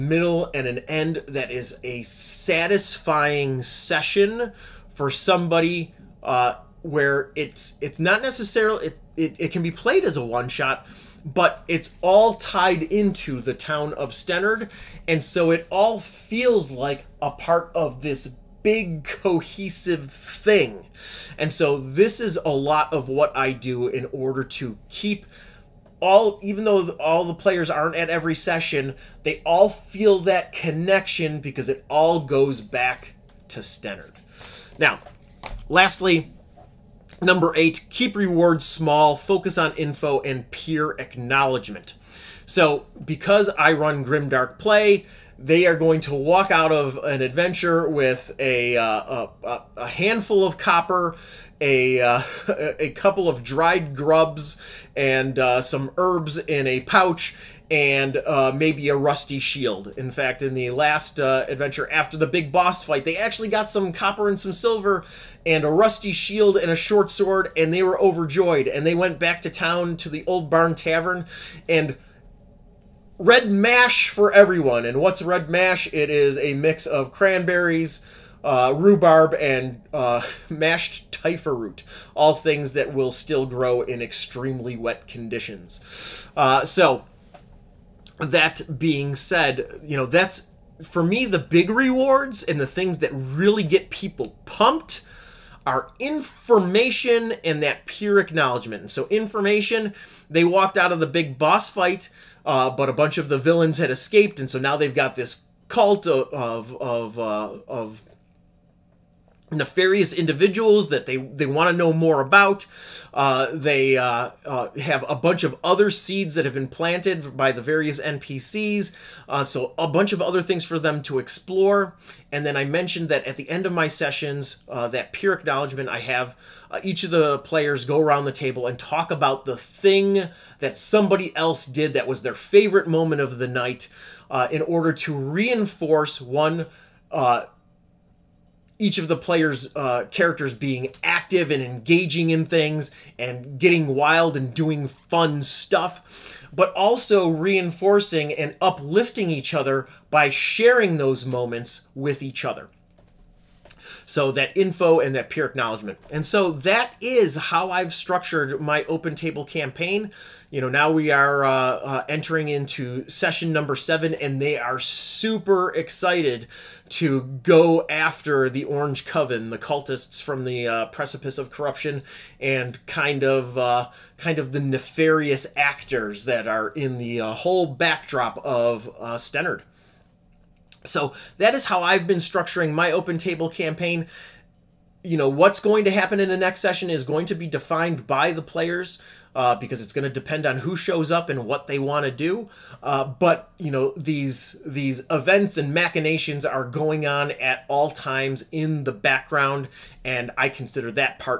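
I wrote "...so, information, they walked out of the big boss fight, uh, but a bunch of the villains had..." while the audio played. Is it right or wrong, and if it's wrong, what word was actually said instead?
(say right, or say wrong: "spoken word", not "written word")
right.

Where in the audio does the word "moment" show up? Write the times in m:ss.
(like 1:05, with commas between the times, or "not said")
2:12, 2:31.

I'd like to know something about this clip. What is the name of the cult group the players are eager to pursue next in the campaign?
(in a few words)
Orange Coven.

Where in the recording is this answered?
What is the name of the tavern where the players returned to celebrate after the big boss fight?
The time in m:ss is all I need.
1:10.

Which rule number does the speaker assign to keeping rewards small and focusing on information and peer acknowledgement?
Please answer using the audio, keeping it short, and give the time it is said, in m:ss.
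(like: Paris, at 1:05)
8, at 0:37.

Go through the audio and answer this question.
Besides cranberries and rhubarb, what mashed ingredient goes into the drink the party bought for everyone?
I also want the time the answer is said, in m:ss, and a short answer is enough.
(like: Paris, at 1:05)
typha root, at 1:21.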